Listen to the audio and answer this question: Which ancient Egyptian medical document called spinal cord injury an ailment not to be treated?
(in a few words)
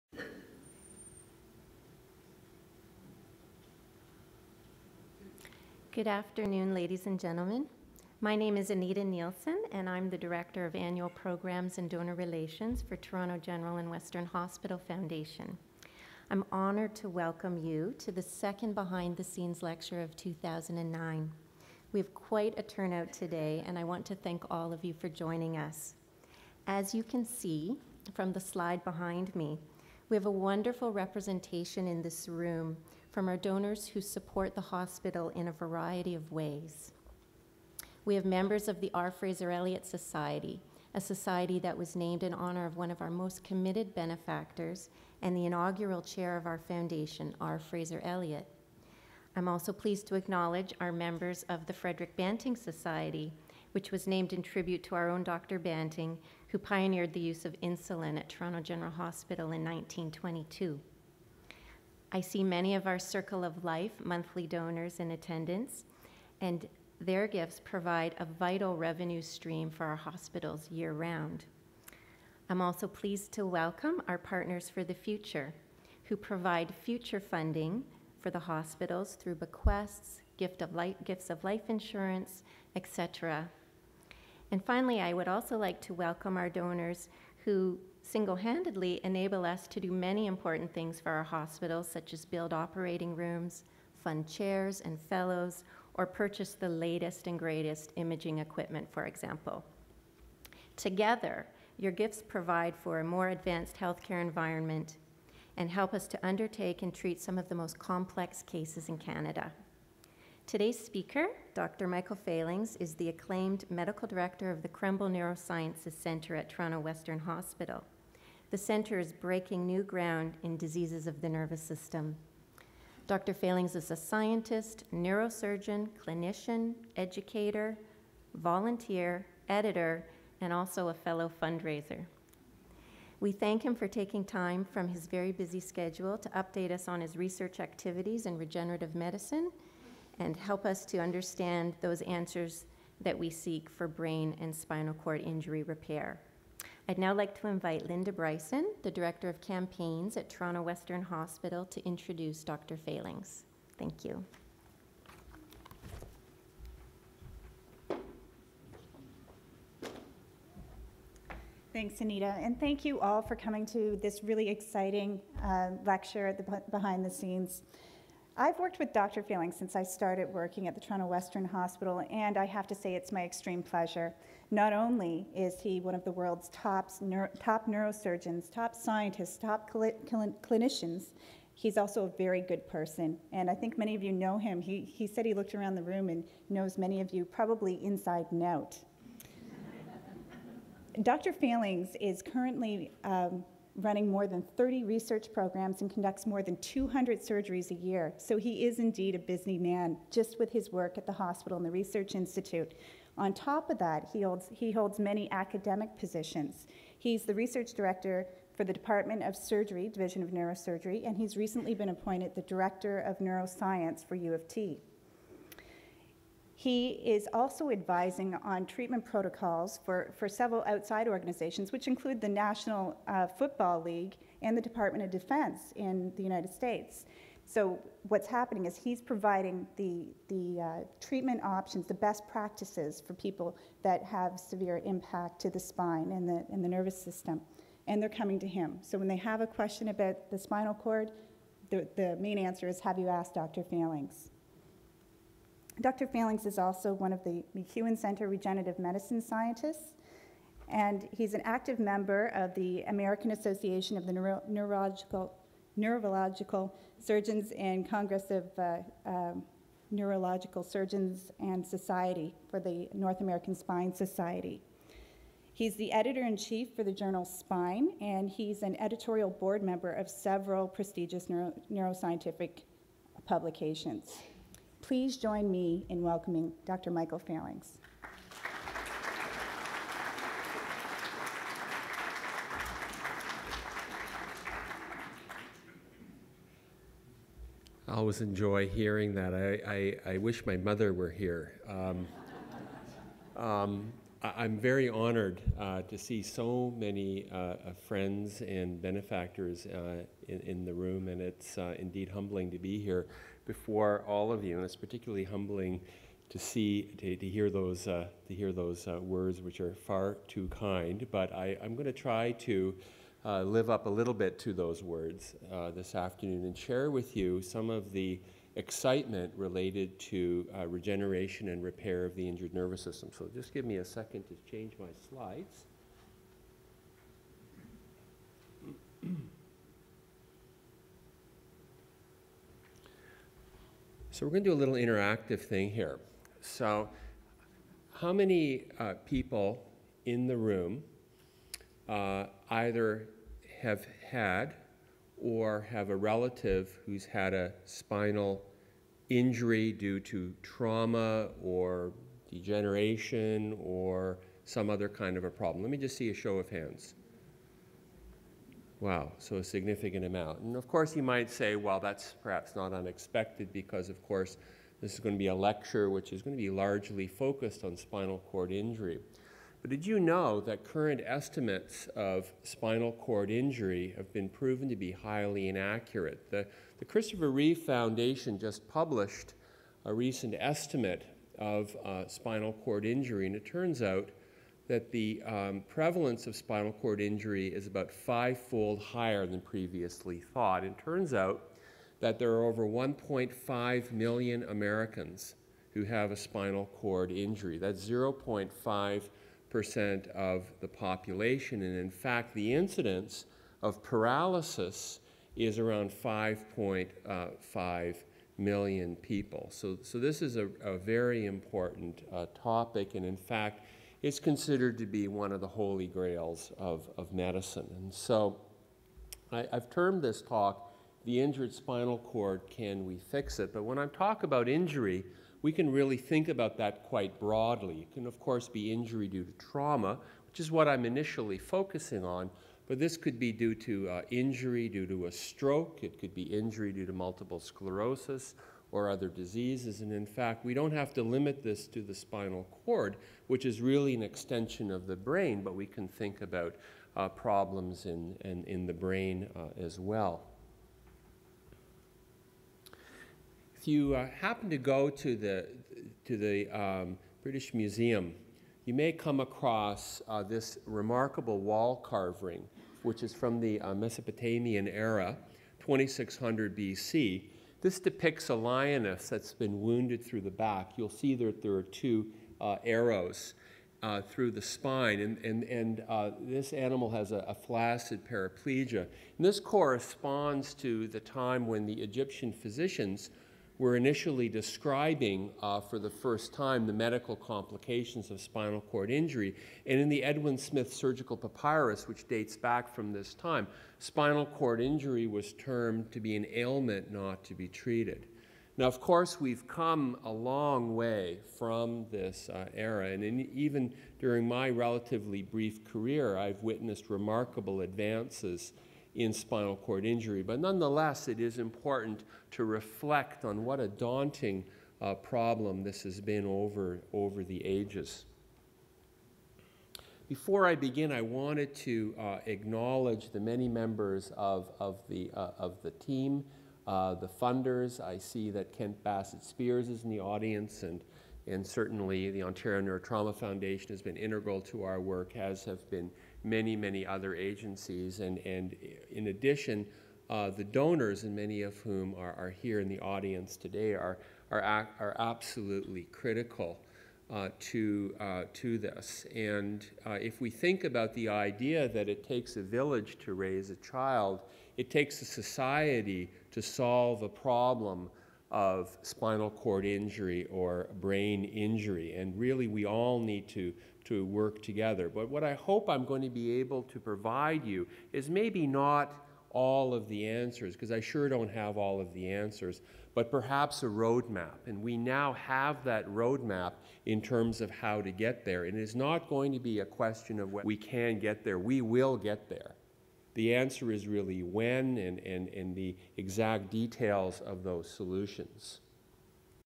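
Edwin Smith Surgical Papyrus.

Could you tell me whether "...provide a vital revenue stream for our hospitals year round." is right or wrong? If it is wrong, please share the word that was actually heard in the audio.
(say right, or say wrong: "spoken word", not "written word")
right.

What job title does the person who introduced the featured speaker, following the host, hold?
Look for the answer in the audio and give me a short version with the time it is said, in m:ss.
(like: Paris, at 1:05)
Director of Campaigns, at 2:28.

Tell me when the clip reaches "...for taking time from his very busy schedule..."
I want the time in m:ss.
2:13.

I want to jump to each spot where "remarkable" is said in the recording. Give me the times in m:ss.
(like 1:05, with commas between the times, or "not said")
7:40, 8:26.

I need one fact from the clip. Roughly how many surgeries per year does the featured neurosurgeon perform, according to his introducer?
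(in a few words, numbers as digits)
200.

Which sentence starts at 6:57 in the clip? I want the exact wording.
And so I, I've termed this talk, The Injured Spinal Cord Can We Fix It?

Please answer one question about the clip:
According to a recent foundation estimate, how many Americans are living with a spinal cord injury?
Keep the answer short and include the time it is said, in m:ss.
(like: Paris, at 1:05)
1.5 million, at 6:32.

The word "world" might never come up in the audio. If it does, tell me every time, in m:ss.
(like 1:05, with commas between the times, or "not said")
2:56.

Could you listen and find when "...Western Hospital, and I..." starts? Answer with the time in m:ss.
2:51.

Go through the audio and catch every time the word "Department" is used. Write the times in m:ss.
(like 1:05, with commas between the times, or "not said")
3:28, 3:44.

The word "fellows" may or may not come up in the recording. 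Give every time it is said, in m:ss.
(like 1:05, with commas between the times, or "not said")
1:35, 2:10.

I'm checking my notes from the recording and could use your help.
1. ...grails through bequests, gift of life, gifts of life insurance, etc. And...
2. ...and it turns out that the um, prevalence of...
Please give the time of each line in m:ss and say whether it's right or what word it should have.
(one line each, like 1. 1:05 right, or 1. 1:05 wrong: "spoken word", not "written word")
1. 1:18 wrong: "hospitals", not "grails"
2. 6:23 right.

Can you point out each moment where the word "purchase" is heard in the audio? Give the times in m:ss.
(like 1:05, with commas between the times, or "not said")
1:36.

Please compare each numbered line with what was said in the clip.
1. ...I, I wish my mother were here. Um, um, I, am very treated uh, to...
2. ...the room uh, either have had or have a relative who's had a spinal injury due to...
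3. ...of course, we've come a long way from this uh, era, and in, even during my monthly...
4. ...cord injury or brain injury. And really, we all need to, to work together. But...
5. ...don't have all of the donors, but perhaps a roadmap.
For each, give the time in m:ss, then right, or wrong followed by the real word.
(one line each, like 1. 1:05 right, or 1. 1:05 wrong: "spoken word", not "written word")
1. 4:50 wrong: "honored", not "treated"
2. 5:40 right
3. 8:18 wrong: "relatively", not "monthly"
4. 9:19 right
5. 9:31 wrong: "answers", not "donors".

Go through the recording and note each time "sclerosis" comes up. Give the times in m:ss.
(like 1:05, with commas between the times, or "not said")
7:17.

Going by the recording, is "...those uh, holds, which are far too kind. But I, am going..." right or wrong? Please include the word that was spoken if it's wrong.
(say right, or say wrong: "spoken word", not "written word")
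wrong: "words", not "holds".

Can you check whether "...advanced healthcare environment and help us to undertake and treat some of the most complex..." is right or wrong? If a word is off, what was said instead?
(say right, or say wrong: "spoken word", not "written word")
right.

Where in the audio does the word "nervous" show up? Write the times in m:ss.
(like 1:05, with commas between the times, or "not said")
2:01, 3:56, 5:22.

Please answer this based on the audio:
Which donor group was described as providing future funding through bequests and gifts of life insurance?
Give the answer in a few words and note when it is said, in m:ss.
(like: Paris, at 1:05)
Partners for the Future, at 1:14.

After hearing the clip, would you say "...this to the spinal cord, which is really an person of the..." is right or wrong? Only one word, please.
wrong.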